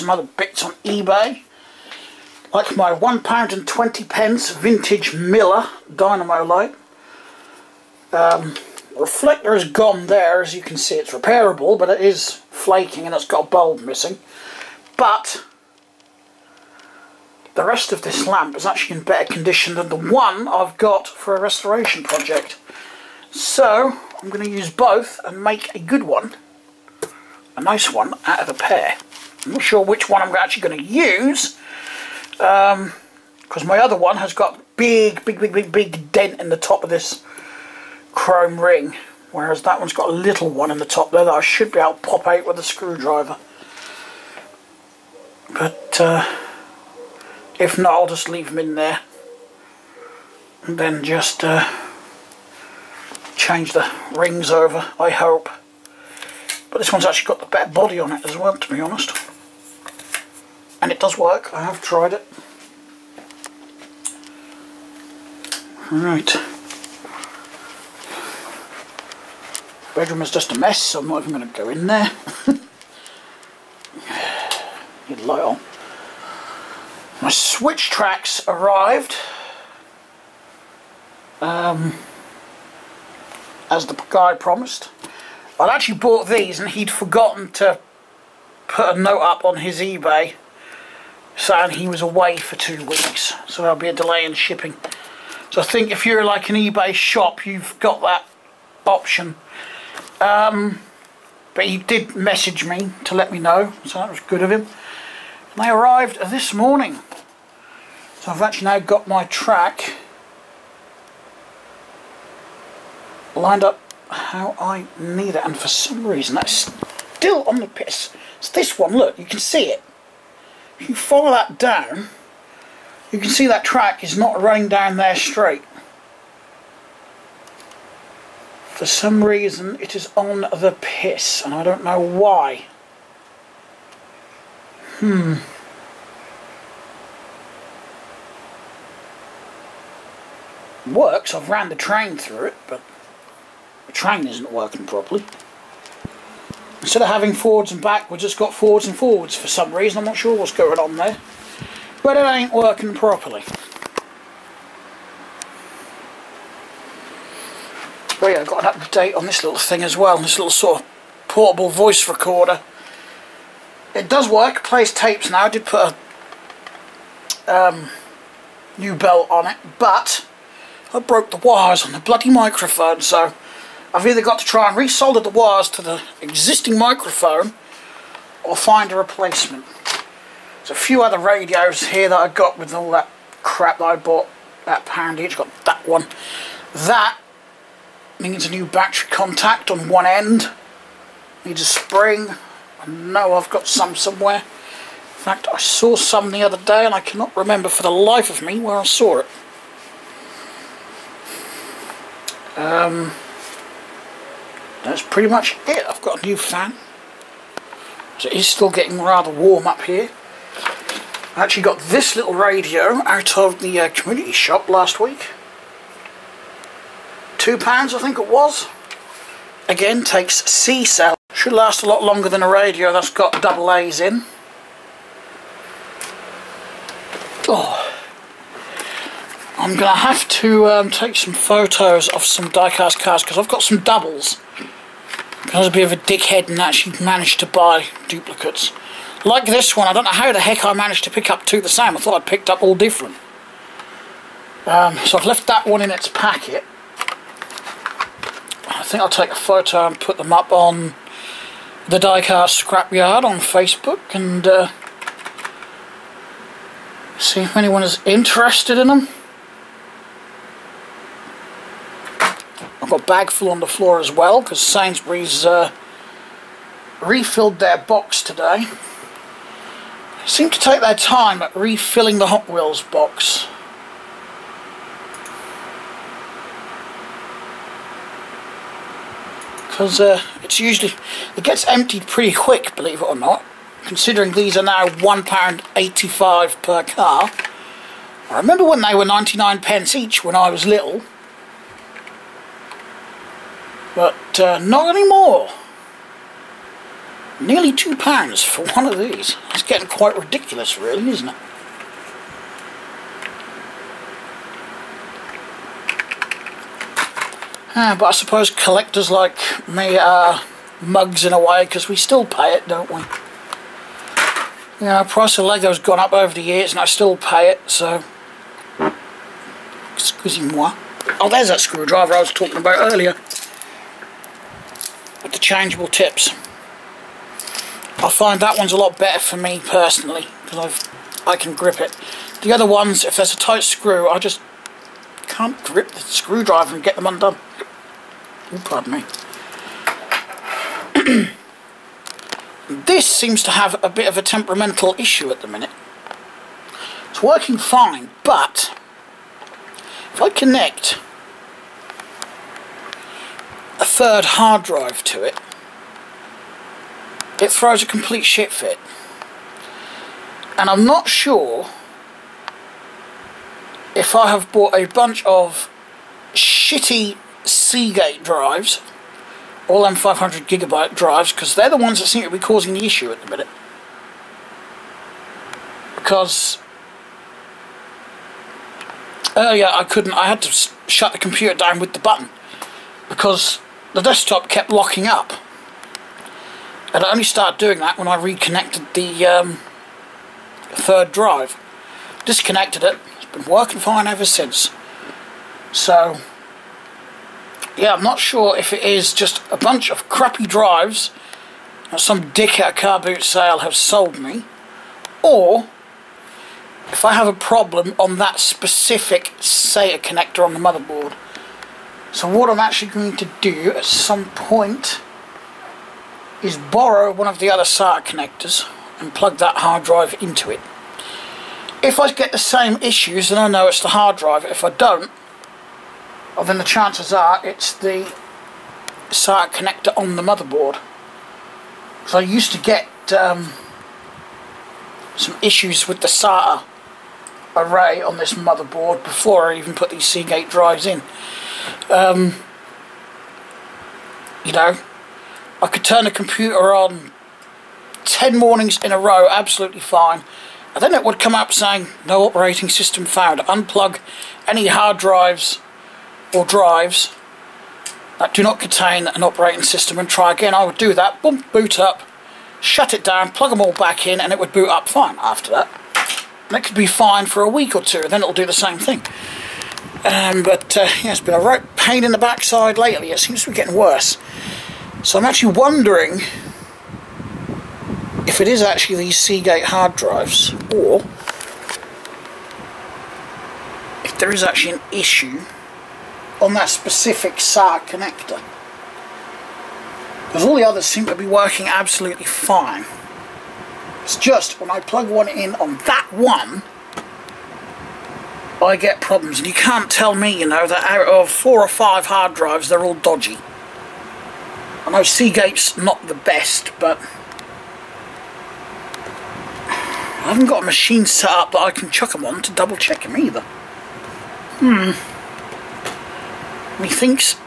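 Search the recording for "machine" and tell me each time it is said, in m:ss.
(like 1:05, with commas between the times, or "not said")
8:30.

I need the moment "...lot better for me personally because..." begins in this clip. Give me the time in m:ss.
5:28.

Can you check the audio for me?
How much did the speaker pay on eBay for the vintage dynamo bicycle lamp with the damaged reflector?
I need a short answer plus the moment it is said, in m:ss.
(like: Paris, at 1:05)
£1.20, at 0:02.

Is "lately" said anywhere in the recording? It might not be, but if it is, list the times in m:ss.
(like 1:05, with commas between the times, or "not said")
7:52.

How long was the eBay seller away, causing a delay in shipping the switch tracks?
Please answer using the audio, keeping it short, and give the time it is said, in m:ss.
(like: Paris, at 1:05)
2 weeks, at 1:32.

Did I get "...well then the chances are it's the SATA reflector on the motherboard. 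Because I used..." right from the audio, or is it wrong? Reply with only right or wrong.
wrong.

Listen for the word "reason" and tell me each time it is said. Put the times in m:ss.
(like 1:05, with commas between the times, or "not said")
1:56, 2:09, 2:29.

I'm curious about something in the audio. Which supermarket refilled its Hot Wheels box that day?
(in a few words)
Sainsbury's.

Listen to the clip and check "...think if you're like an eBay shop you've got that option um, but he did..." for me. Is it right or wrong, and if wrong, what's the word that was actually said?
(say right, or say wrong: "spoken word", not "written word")
right.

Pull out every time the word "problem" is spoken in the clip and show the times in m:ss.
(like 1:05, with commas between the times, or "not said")
6:47, 8:19.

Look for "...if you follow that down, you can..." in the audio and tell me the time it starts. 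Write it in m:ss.
2:00.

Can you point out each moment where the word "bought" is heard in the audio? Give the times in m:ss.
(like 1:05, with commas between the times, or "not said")
1:25, 3:03, 6:04.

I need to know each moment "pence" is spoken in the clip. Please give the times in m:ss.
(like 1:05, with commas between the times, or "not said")
0:04, 4:49.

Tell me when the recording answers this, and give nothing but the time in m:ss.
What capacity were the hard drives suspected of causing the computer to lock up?
6:09.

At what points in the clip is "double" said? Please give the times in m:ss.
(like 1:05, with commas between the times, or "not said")
3:43, 3:53, 8:32.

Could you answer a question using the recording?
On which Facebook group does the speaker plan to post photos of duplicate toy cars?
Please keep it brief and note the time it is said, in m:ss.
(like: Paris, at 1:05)
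Diecast Scrapyard, at 4:11.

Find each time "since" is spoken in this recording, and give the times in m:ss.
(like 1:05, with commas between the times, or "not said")
6:34.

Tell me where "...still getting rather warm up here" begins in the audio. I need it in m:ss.
3:28.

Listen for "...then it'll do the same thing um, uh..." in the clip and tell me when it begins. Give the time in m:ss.
7:48.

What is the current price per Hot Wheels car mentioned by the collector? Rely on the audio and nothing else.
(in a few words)
£1.85.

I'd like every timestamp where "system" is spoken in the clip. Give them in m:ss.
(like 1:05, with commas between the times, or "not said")
7:32, 7:39.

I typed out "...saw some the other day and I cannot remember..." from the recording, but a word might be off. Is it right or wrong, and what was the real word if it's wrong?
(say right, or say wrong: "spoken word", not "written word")
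right.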